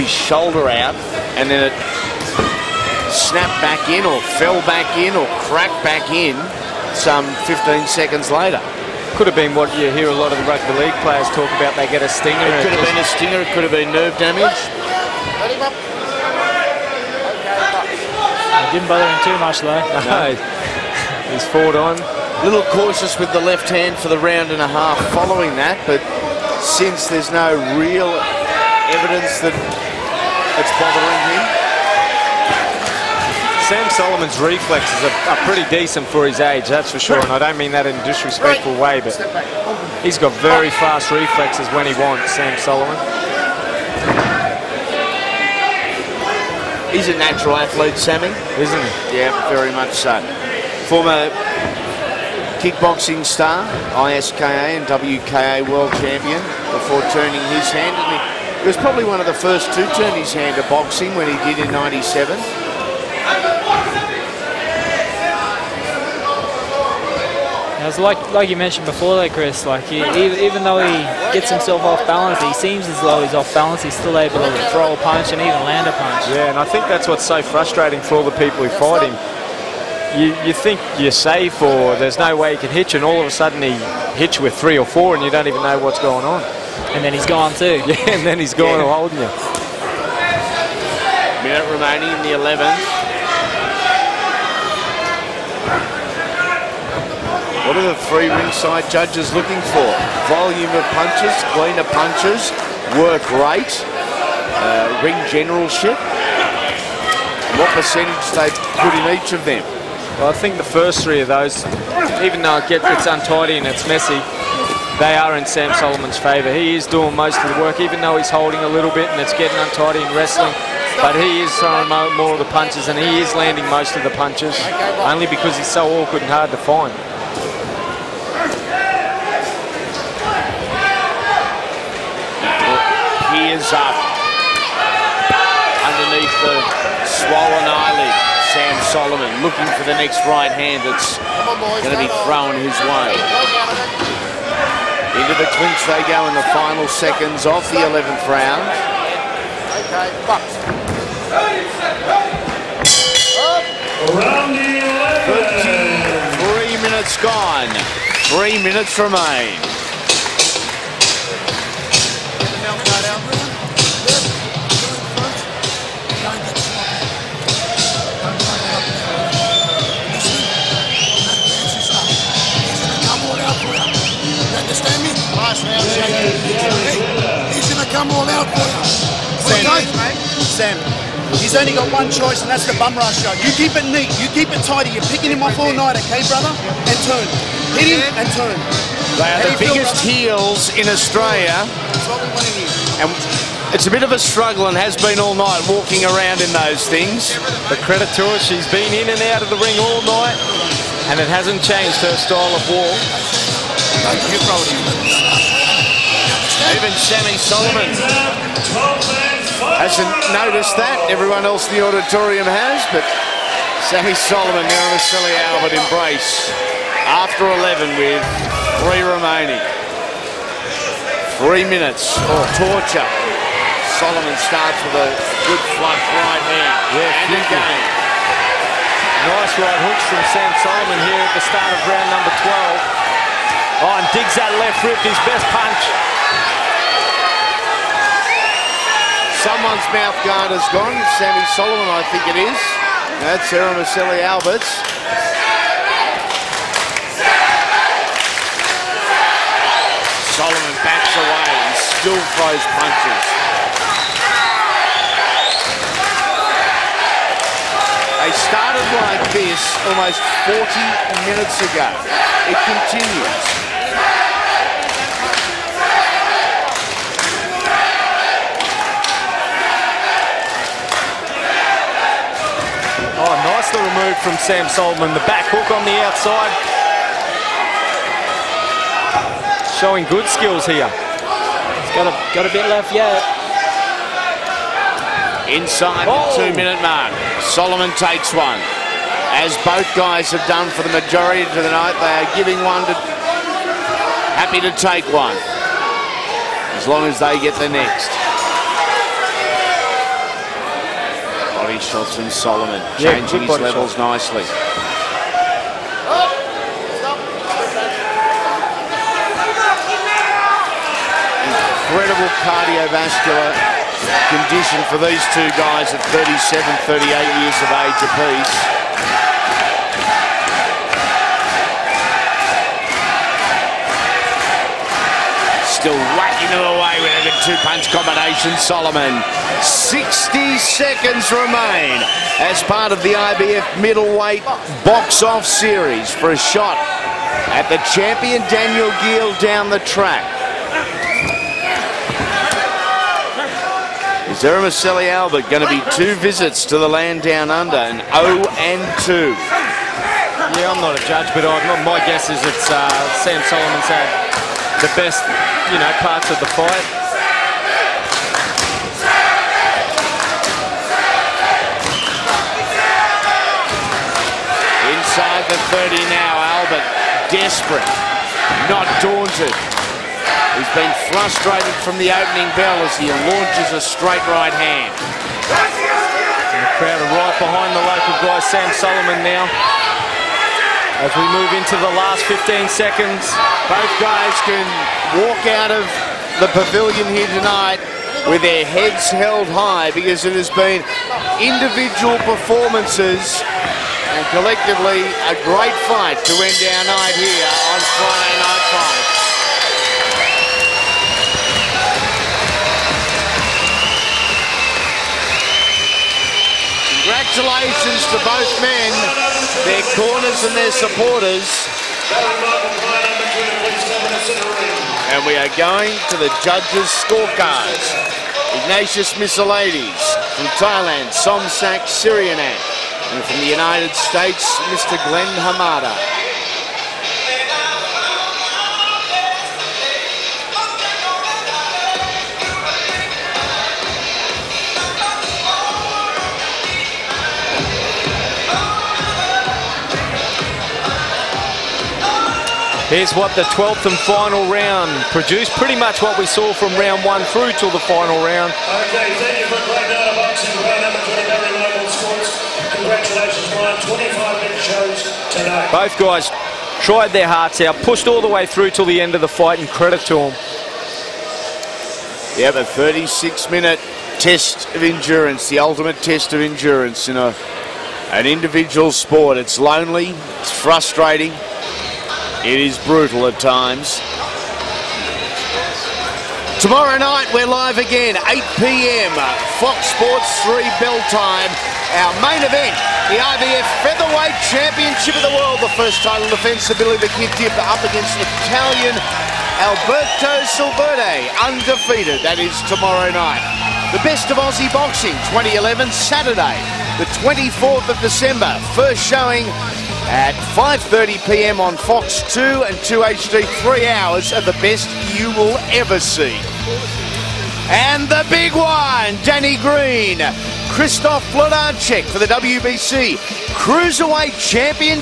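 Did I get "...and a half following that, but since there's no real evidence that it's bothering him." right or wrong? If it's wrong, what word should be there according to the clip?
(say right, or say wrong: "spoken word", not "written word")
right.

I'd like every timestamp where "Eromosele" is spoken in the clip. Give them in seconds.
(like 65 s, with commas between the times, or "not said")
344 s.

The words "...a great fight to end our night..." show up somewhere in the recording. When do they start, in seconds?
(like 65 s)
395 s.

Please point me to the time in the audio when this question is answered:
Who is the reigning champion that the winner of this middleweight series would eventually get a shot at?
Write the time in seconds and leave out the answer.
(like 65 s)
338 s.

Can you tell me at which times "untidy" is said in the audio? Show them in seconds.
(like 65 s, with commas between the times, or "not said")
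113 s, 119 s.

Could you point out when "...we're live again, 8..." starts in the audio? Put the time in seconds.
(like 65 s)
477 s.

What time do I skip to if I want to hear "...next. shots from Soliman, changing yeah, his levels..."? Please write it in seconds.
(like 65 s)
297 s.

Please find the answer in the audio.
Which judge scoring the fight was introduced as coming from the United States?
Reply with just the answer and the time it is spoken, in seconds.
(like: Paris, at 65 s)
Glenn Hamada, at 425 s.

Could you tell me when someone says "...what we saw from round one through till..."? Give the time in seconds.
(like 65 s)
446 s.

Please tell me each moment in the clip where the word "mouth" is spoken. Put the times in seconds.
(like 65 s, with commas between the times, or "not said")
239 s.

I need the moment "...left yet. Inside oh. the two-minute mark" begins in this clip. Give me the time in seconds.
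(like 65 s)
282 s.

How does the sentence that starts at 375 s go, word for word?
And the crowd are right behind the local guy, Sam Soliman now.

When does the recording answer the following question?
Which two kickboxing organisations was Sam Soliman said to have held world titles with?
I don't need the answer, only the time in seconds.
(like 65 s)
54 s.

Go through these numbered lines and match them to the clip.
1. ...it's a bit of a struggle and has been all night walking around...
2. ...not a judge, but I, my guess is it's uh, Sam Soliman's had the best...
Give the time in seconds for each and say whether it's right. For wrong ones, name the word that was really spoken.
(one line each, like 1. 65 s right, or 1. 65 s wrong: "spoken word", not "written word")
1. 193 s right
2. 350 s right.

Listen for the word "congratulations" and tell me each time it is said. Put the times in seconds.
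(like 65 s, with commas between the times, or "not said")
406 s, 452 s.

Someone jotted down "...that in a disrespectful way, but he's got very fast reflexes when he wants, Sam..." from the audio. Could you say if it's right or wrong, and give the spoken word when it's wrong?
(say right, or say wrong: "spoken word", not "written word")
right.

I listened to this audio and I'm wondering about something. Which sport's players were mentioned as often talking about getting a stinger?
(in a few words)
Rugby league.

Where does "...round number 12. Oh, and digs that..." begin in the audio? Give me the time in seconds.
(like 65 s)
231 s.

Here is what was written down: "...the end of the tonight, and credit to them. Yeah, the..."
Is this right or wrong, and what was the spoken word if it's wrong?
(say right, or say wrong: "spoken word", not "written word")
wrong: "fight", not "tonight".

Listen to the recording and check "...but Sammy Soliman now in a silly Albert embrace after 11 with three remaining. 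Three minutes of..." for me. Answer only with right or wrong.
right.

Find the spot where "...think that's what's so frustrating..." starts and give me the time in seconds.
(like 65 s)
76 s.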